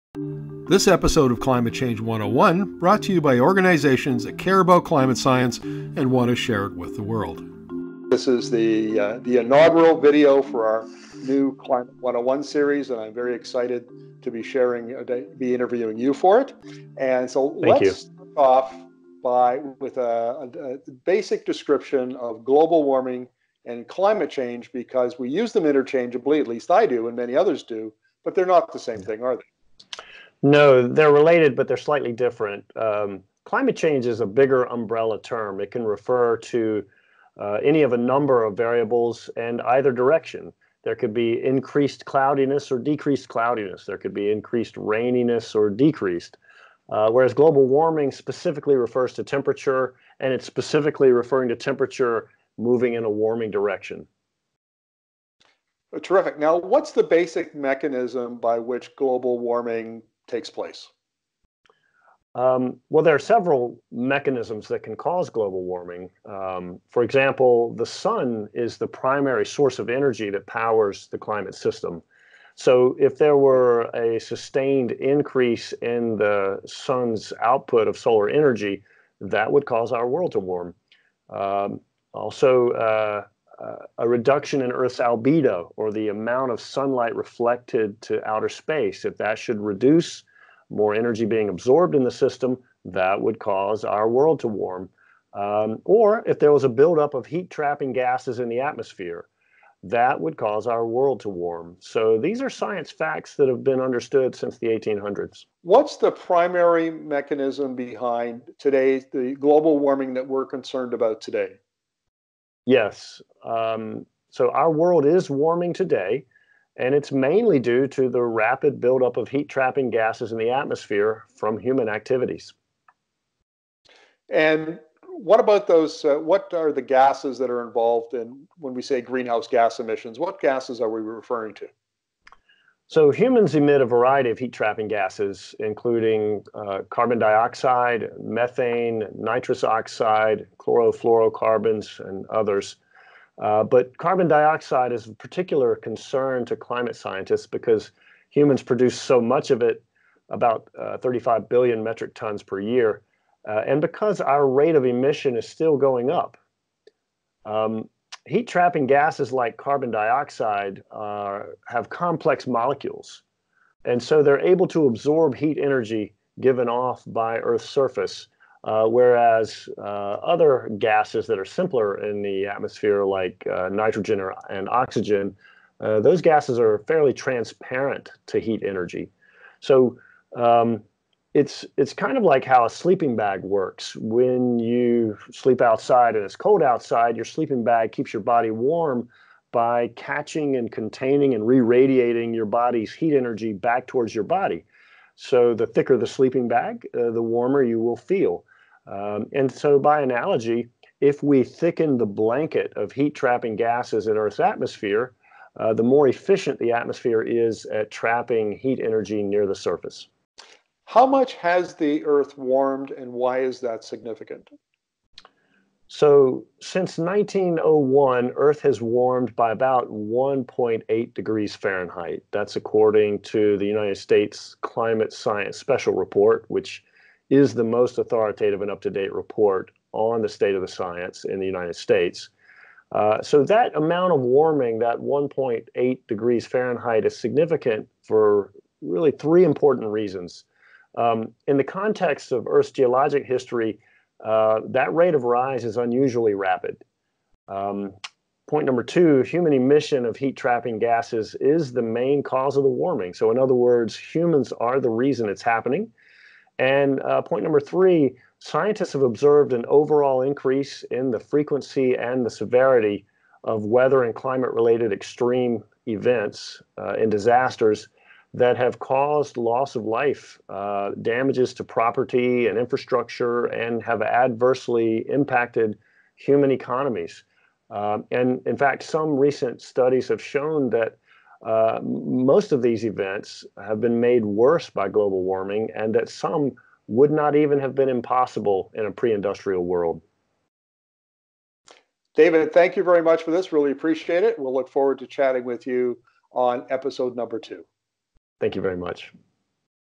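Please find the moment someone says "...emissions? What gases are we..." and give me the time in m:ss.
2:09.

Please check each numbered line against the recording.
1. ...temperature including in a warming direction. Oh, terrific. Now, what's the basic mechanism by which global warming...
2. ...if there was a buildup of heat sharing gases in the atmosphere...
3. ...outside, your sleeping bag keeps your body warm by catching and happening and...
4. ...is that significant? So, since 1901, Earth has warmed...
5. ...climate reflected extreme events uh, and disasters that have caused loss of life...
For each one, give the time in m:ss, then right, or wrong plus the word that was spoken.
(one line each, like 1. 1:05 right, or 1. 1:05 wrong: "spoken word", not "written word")
1. 0:51 wrong: "moving", not "including"
2. 1:36 wrong: "trapping", not "sharing"
3. 3:06 wrong: "containing", not "happening"
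4. 3:33 right
5. 4:24 wrong: "related", not "reflected".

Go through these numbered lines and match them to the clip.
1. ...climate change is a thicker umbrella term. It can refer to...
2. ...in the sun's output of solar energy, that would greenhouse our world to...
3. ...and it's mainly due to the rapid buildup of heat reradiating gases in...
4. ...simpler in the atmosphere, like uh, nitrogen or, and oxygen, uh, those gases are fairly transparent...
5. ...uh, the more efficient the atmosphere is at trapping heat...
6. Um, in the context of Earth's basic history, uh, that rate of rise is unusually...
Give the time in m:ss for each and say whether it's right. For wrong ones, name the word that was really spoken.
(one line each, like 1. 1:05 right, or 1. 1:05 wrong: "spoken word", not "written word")
1. 0:33 wrong: "bigger", not "thicker"
2. 1:15 wrong: "cause", not "greenhouse"
3. 1:56 wrong: "trapping", not "reradiating"
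4. 2:51 right
5. 3:25 right
6. 4:00 wrong: "geologic", not "basic".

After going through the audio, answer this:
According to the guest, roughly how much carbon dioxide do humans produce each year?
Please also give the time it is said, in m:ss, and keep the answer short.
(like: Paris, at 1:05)
35 billion metric tons, at 2:30.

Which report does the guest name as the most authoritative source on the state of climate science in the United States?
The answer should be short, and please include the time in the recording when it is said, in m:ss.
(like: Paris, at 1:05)
United States Climate Science Special Report, at 3:43.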